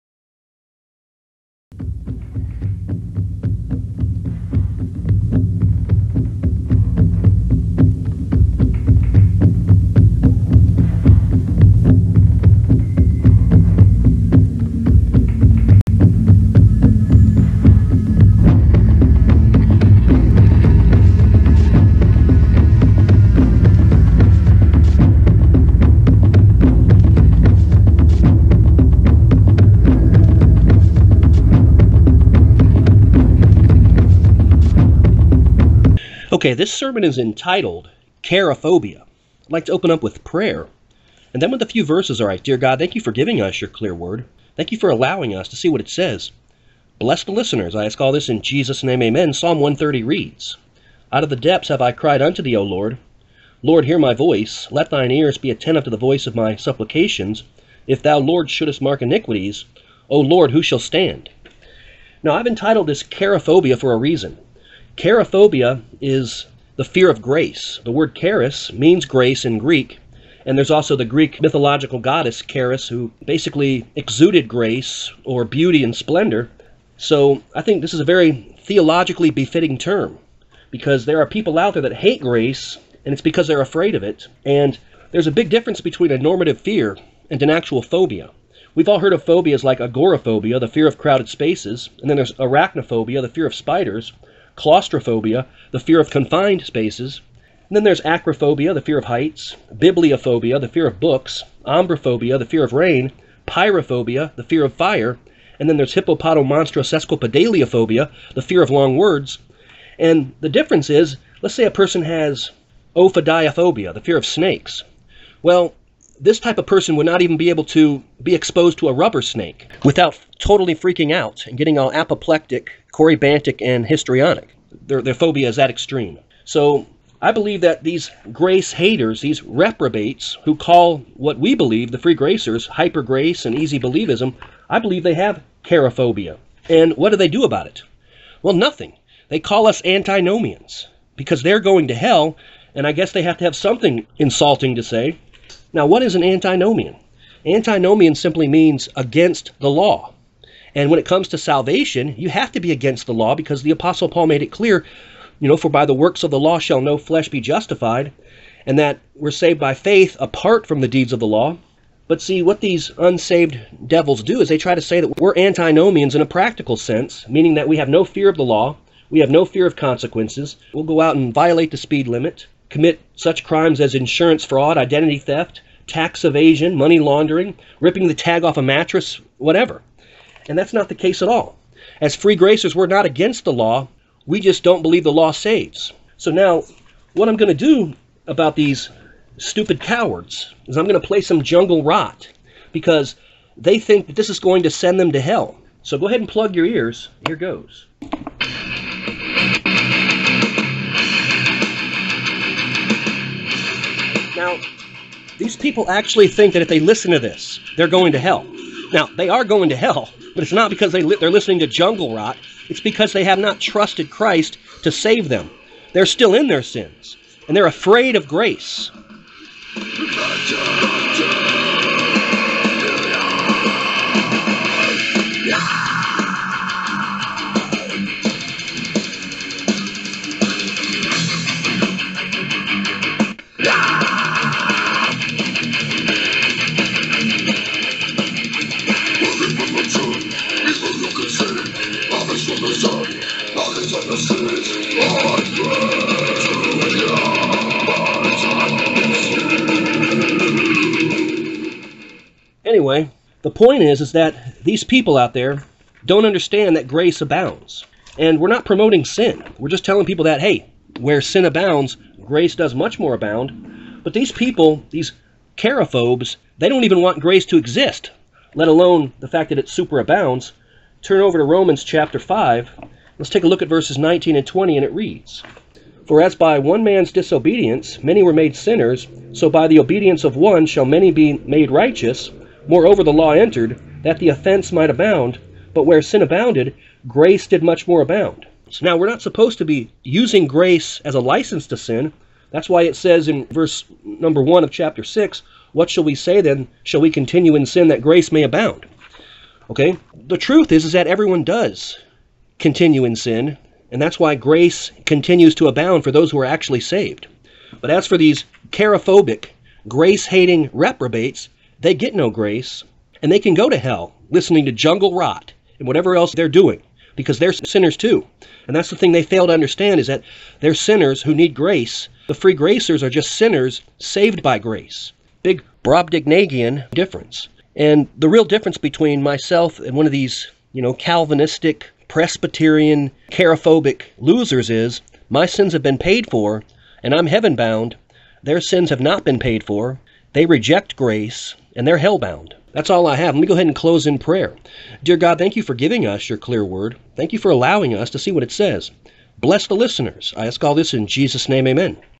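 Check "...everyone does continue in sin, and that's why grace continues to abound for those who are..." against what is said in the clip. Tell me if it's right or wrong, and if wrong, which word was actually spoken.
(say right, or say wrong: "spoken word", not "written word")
right.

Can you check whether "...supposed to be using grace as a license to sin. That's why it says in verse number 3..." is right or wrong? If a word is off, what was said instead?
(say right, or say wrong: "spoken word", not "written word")
wrong: "1", not "3".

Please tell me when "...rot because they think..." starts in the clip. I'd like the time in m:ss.
3:11.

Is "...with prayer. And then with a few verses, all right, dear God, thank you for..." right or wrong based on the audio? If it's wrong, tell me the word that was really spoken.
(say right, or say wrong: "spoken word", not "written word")
right.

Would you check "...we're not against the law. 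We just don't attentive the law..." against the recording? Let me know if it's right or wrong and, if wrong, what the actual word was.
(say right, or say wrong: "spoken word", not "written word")
wrong: "believe", not "attentive".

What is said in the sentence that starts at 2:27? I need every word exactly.
Antinomian simply means against the law.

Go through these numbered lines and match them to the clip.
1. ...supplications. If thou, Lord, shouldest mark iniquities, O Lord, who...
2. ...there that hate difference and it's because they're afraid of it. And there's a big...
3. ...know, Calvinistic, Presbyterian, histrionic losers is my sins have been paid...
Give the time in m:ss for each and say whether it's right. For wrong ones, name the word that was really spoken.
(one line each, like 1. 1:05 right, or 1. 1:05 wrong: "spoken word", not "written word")
1. 0:56 right
2. 1:21 wrong: "grace", not "difference"
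3. 5:30 wrong: "chariphobic", not "histrionic".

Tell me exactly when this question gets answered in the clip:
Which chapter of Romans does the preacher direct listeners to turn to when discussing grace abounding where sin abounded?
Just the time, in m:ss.
4:31.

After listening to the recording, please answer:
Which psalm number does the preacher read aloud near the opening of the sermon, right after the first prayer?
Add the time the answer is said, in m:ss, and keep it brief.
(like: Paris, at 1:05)
Psalm 130, at 0:49.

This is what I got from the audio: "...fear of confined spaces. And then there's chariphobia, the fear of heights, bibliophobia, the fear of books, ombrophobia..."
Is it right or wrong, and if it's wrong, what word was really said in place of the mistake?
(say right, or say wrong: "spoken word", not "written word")
wrong: "acrophobia", not "chariphobia".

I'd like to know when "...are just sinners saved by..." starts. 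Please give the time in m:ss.
5:23.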